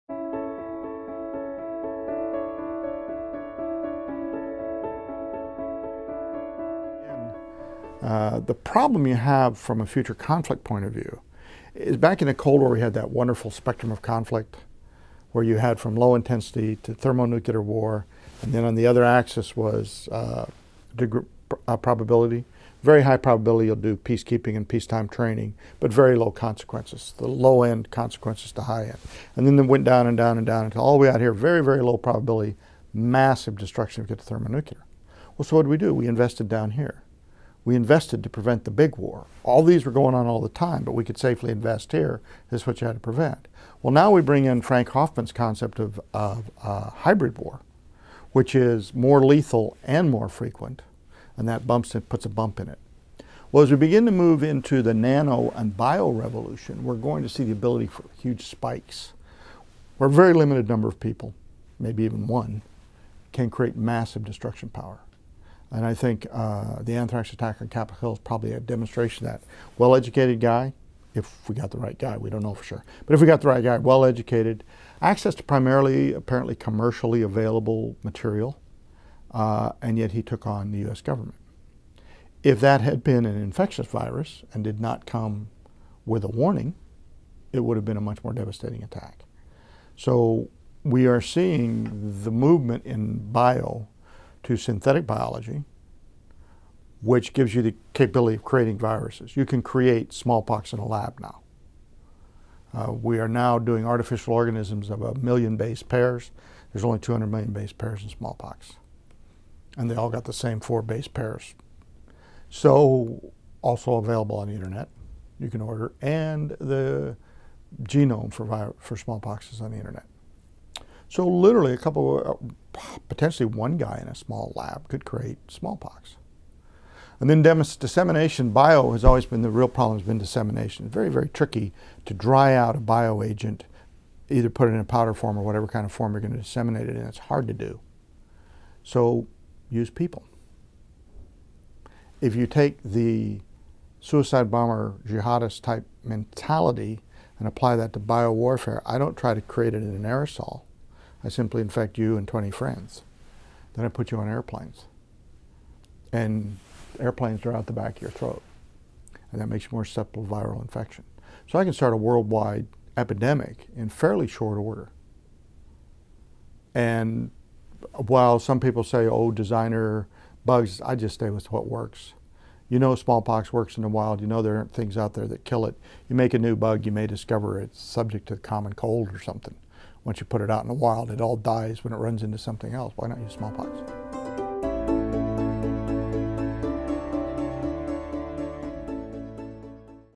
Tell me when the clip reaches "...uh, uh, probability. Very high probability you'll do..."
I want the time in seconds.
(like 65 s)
20 s.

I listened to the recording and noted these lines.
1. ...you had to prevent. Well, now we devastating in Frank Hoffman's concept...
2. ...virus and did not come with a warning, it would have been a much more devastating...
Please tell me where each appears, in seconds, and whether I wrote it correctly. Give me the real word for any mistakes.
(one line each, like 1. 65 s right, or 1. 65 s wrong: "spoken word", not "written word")
1. 42 s wrong: "bring", not "devastating"
2. 83 s right.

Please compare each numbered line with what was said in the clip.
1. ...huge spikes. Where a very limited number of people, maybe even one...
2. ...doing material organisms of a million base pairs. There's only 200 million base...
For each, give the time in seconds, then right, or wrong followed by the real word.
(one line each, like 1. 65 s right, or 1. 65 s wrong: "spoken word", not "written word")
1. 58 s right
2. 103 s wrong: "artificial", not "material".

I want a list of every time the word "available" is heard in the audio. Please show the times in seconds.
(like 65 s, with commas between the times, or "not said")
77 s, 113 s.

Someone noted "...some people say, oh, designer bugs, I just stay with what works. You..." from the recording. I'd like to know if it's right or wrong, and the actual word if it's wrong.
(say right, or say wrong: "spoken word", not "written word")
right.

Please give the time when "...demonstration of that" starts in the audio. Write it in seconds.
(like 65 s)
68 s.